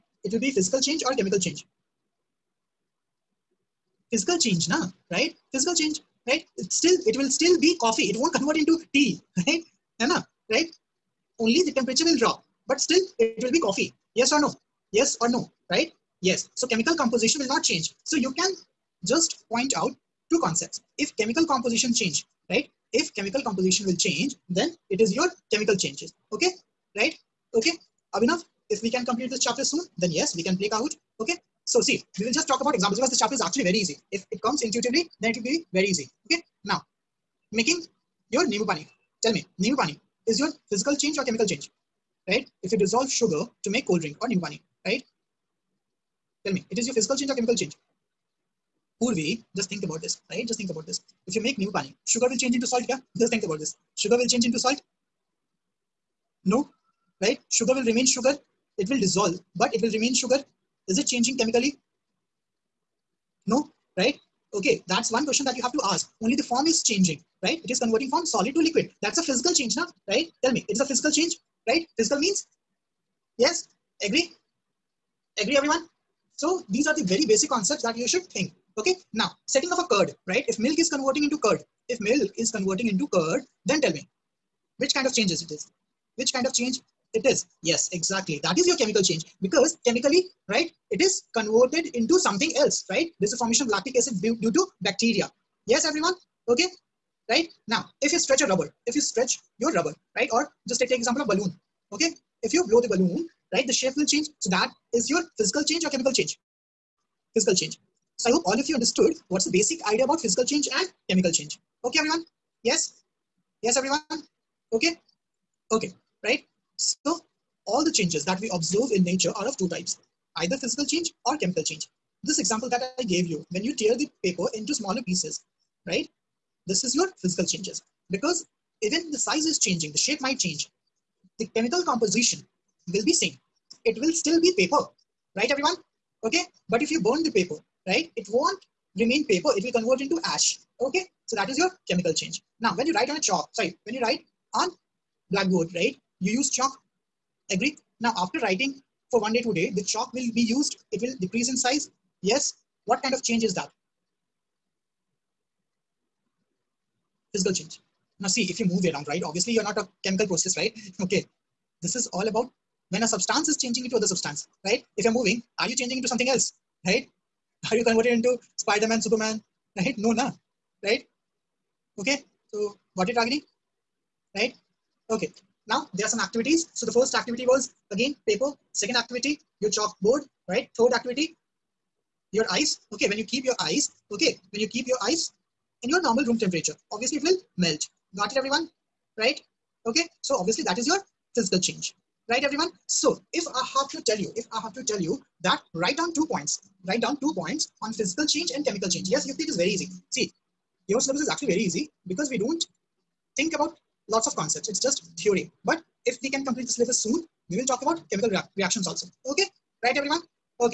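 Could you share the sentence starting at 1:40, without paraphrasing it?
Or just take, take example of balloon, okay?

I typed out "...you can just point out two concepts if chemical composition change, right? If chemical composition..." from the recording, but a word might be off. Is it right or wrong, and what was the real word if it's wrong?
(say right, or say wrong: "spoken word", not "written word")
right.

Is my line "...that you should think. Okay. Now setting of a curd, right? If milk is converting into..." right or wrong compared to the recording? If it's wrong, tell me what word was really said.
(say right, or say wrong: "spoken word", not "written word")
right.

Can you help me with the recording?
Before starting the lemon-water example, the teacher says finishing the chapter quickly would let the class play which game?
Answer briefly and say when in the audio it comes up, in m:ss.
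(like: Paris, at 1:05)
Kahoot, at 0:30.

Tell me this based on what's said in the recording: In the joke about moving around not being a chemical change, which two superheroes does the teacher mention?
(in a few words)
Spider-Man, Superman.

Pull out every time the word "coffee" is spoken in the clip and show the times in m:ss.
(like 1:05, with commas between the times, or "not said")
0:07, 0:13.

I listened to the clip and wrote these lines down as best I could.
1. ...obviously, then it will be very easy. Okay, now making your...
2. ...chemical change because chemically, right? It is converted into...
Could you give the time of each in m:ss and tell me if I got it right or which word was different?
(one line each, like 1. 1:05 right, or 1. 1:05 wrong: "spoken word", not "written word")
1. 0:34 wrong: "intuitively", not "obviously"
2. 1:28 right.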